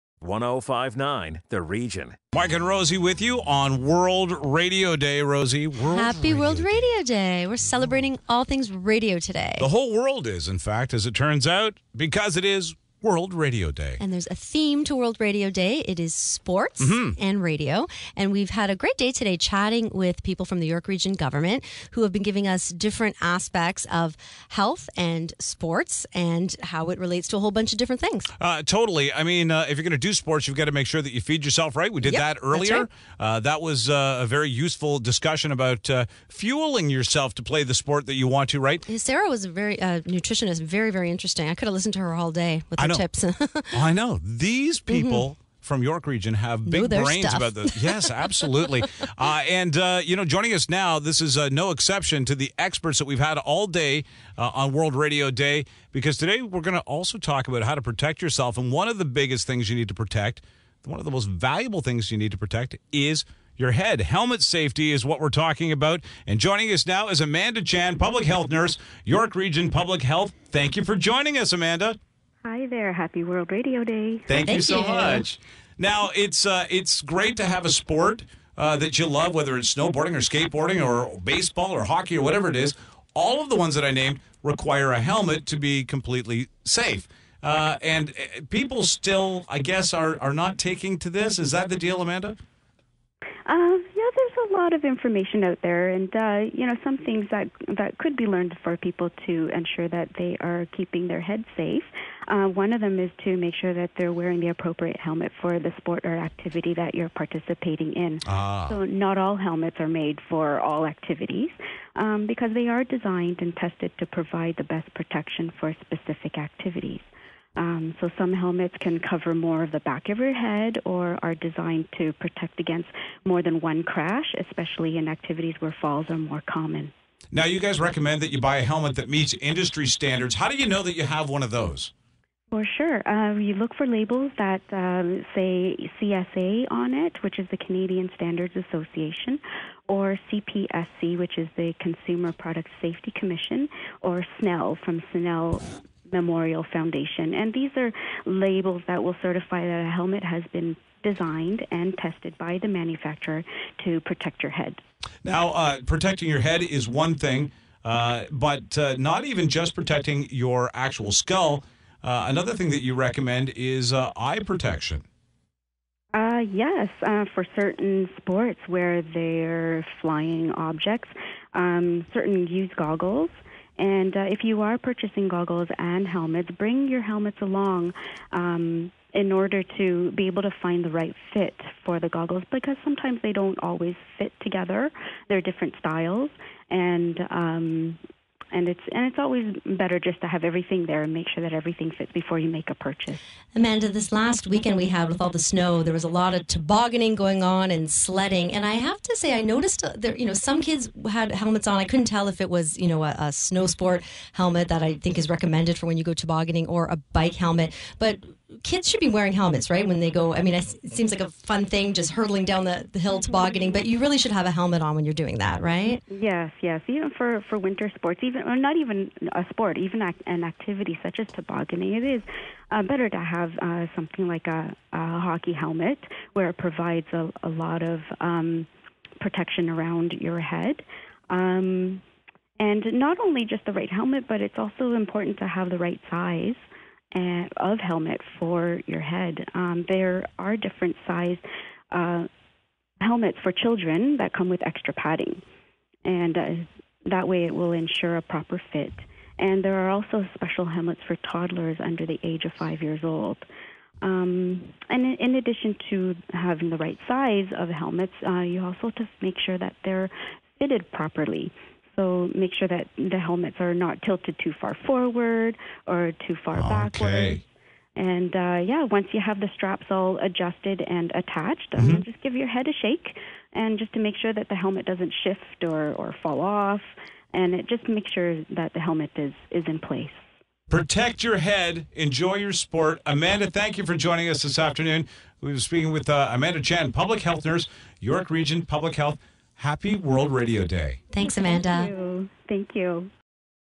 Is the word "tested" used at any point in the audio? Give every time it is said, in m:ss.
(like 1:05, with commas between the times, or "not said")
1:53, 2:31.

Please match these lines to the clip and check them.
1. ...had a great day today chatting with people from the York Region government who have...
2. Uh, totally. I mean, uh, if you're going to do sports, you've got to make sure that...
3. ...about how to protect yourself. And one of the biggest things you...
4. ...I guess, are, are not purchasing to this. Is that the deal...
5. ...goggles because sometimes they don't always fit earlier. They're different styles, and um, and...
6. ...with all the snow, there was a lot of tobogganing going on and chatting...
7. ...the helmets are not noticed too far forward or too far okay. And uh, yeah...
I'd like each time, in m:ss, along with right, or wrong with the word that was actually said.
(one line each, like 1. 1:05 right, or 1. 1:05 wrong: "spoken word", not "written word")
1. 0:18 right
2. 0:28 right
3. 0:57 right
4. 1:29 wrong: "taking", not "purchasing"
5. 3:02 wrong: "together", not "earlier"
6. 3:15 wrong: "sledding", not "chatting"
7. 4:22 wrong: "tilted", not "noticed".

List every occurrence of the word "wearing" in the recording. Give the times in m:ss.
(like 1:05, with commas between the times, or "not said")
1:44, 3:29.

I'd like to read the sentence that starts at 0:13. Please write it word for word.
And there's a theme to World Radio Day.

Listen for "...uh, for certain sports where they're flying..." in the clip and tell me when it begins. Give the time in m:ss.
2:47.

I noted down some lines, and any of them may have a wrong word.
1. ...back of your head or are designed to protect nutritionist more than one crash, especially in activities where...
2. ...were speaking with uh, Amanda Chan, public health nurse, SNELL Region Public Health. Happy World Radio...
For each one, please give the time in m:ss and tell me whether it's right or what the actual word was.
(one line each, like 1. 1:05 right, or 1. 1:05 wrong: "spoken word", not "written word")
1. 1:59 wrong: "against", not "nutritionist"
2. 4:45 wrong: "York", not "SNELL".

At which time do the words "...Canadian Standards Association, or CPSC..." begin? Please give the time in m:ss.
2:17.